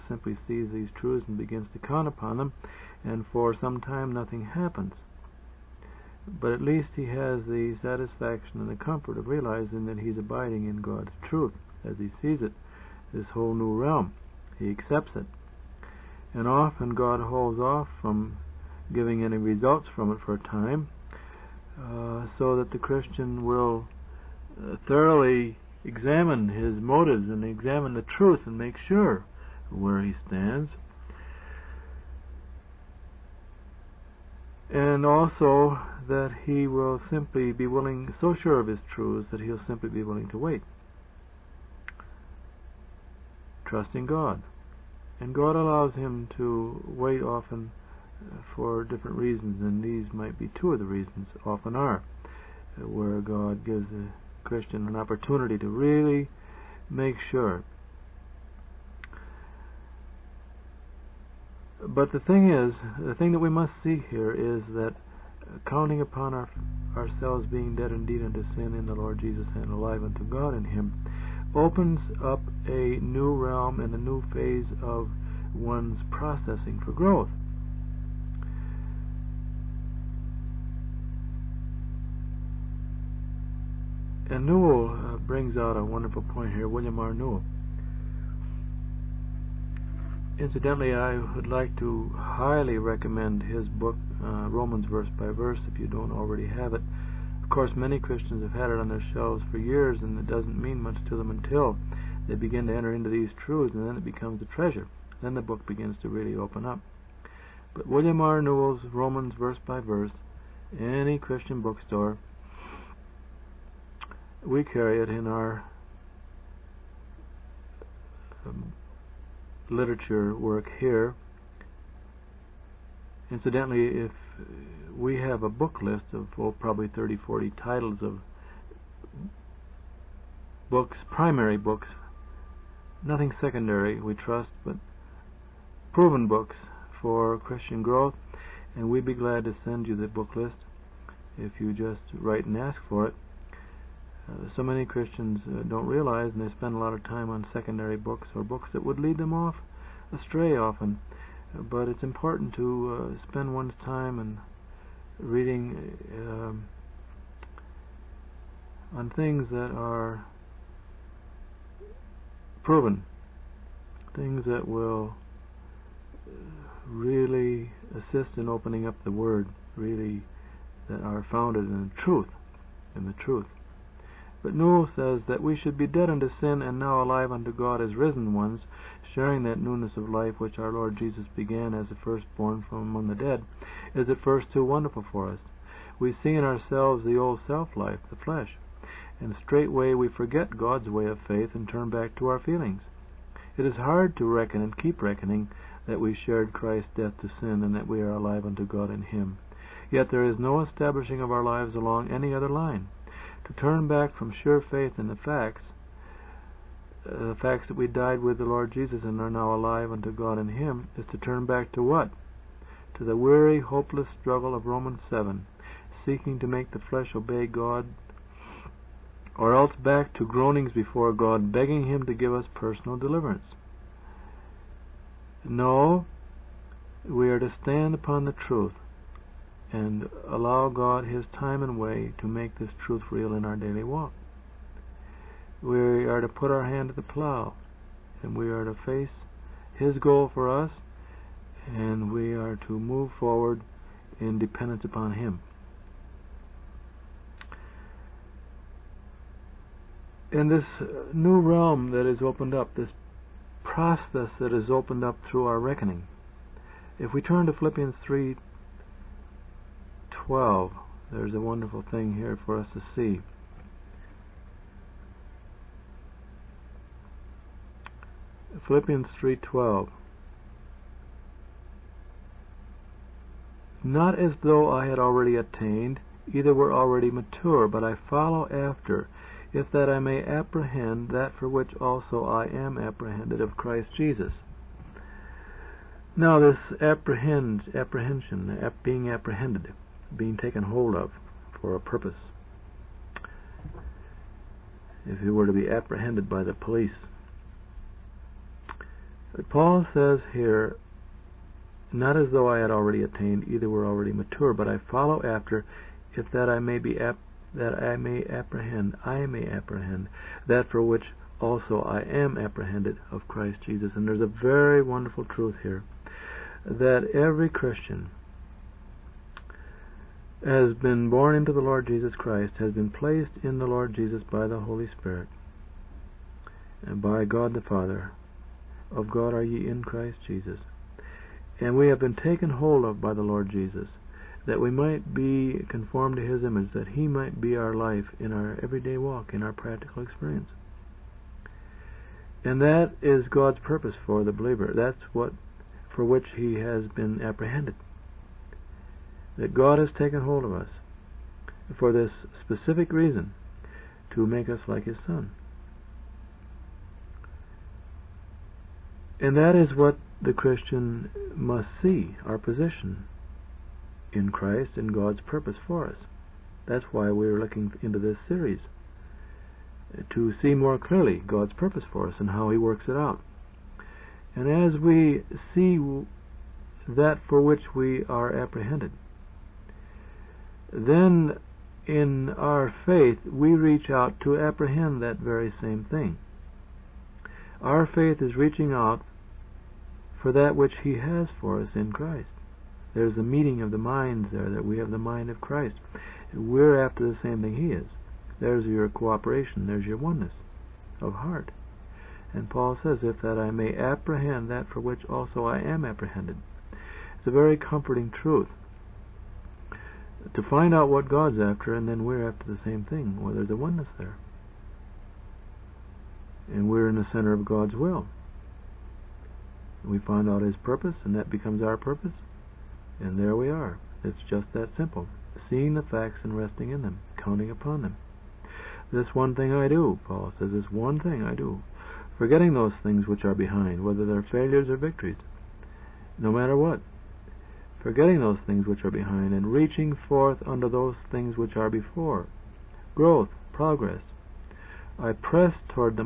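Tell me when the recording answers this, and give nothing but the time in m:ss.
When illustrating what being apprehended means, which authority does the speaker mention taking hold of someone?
4:56.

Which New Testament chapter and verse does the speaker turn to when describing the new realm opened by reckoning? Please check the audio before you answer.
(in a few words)
Philippians 3:12.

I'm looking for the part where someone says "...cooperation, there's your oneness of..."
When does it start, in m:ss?
6:38.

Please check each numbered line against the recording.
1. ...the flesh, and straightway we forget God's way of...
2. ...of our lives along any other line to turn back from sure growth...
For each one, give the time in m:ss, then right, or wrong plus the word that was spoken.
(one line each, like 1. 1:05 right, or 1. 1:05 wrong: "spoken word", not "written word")
1. 3:08 right
2. 3:21 wrong: "faith", not "growth".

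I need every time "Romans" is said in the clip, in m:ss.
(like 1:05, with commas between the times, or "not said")
1:34, 1:48, 3:34.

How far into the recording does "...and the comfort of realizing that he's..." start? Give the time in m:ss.
0:08.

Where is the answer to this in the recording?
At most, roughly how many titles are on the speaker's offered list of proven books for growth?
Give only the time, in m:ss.
2:07.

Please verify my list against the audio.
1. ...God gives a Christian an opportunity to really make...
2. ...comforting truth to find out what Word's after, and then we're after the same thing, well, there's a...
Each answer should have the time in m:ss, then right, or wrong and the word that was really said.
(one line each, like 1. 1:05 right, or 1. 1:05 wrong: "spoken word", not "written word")
1. 0:53 right
2. 6:47 wrong: "God", not "Word".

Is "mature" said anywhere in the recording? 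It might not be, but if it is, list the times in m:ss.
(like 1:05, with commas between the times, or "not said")
4:37, 5:04.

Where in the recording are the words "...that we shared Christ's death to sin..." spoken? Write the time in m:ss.
3:15.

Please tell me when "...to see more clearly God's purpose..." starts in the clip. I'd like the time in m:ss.
6:10.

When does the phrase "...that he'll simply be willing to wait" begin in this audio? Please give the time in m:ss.
0:39.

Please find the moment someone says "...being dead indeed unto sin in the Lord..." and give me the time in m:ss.
1:07.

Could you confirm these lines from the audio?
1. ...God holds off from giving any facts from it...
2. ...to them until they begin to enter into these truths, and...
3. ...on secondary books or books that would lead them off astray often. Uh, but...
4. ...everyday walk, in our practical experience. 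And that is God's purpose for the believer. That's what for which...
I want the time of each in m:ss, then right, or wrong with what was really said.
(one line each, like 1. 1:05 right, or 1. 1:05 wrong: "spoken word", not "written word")
1. 0:16 wrong: "results", not "facts"
2. 1:41 right
3. 2:27 right
4. 5:38 right.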